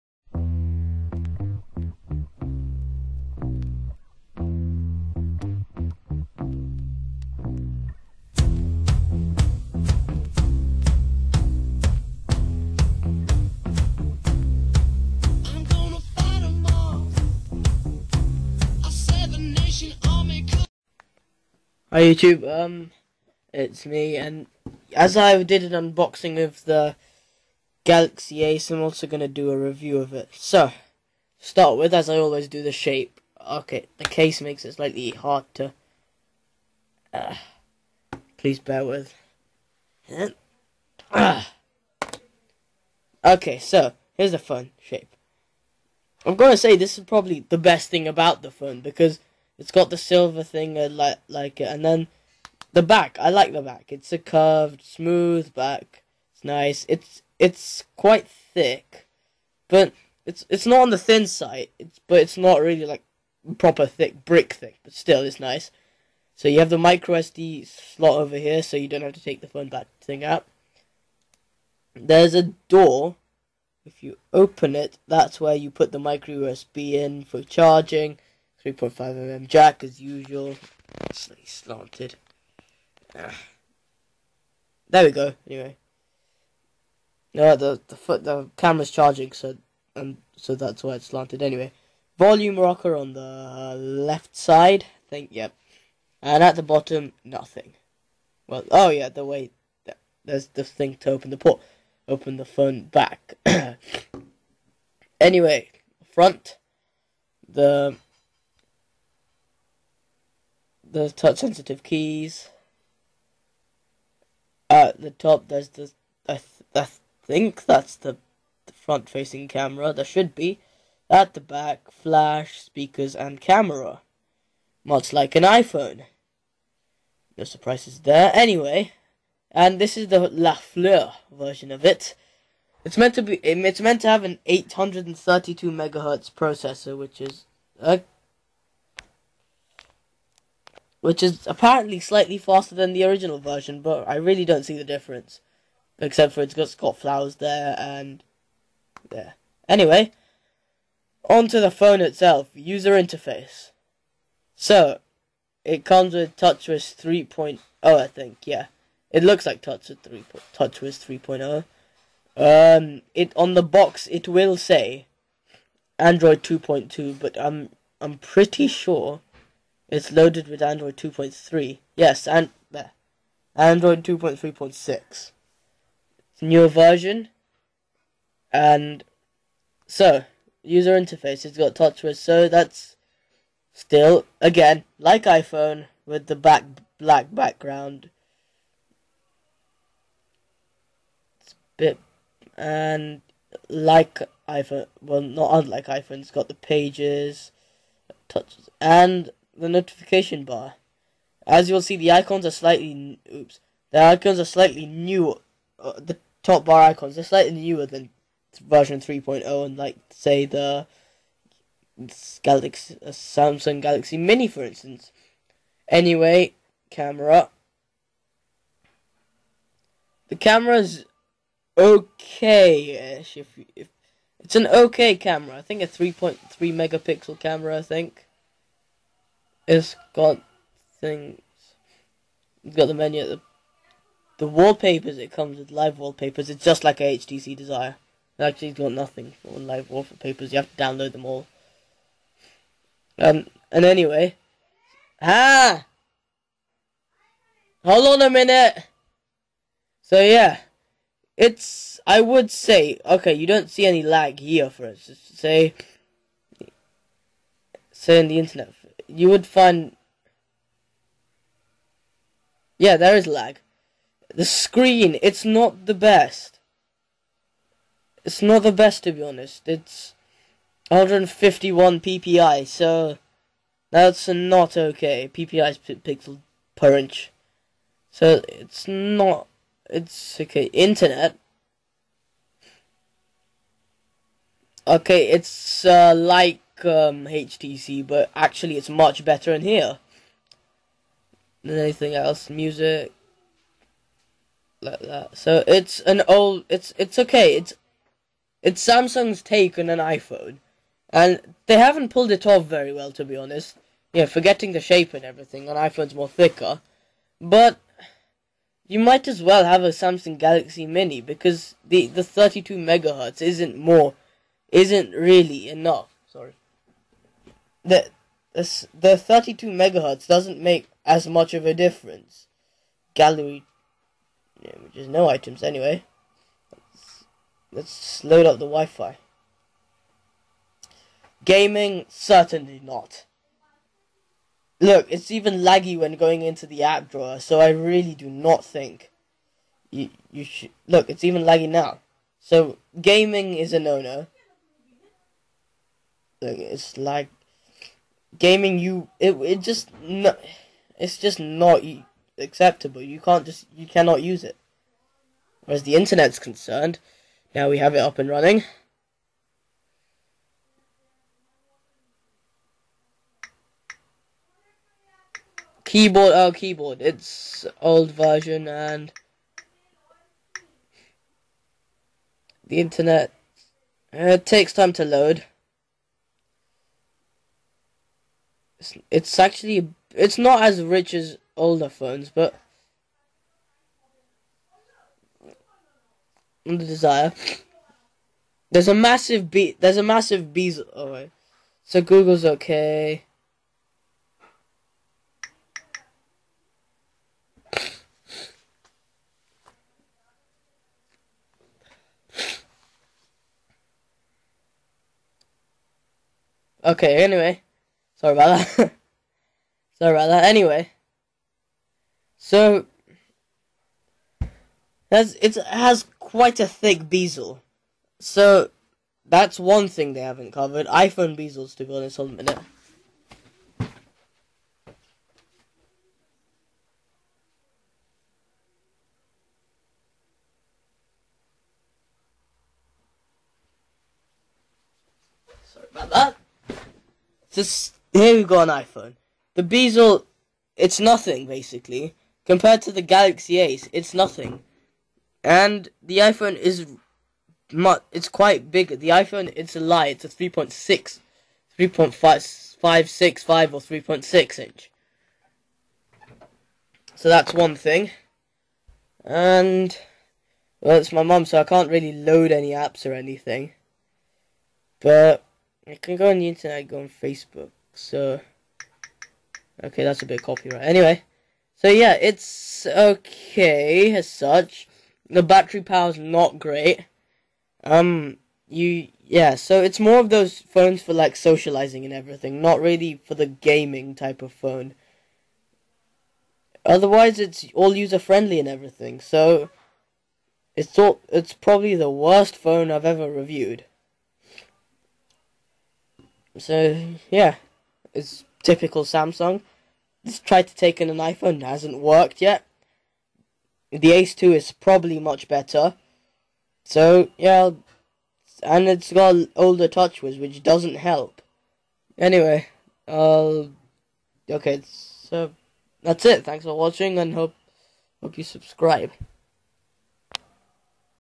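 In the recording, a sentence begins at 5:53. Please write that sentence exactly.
You can't just you cannot use it.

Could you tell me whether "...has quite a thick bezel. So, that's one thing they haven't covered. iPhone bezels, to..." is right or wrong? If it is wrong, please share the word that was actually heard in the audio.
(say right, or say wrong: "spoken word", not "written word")
right.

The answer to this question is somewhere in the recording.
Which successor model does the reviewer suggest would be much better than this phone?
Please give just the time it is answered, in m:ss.
8:24.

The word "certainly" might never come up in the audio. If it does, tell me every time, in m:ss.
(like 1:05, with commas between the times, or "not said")
5:32.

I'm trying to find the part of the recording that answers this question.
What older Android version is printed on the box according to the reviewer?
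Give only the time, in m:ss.
2:45.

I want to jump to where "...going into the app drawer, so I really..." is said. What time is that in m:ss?
5:36.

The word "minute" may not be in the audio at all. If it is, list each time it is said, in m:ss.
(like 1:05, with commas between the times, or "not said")
4:08, 7:02.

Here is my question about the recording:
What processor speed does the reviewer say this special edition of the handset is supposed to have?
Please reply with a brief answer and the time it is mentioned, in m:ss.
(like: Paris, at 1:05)
832 megahertz, at 2:14.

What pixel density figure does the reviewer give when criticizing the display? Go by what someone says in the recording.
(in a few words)
151 ppi.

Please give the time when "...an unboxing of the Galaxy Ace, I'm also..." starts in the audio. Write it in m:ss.
0:25.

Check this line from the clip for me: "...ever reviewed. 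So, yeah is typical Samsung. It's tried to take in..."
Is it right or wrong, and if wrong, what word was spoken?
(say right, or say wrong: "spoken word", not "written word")
right.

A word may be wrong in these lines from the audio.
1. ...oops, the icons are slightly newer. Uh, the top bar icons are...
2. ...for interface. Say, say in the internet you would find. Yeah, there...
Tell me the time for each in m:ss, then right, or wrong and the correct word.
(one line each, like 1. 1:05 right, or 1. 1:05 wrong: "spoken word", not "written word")
1. 3:23 right
2. 4:14 wrong: "instance", not "interface".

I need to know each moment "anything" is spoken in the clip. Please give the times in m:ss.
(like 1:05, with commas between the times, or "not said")
4:51, 7:43.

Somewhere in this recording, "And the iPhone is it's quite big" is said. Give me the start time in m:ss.
7:25.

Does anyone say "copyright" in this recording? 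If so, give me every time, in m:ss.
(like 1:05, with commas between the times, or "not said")
7:50.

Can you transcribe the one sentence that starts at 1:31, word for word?
Anyway, volume rocker on the left side.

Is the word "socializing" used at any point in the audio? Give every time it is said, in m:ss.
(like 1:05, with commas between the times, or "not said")
8:01.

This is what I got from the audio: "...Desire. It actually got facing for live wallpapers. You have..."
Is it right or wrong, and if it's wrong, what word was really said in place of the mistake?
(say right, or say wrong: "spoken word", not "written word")
wrong: "nothing", not "facing".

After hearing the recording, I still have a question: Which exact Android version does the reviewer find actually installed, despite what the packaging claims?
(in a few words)
Android 2.3.6.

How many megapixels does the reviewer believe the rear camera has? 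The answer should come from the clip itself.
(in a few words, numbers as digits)
3.3 megapixels.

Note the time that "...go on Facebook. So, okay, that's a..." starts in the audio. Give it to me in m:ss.
7:46.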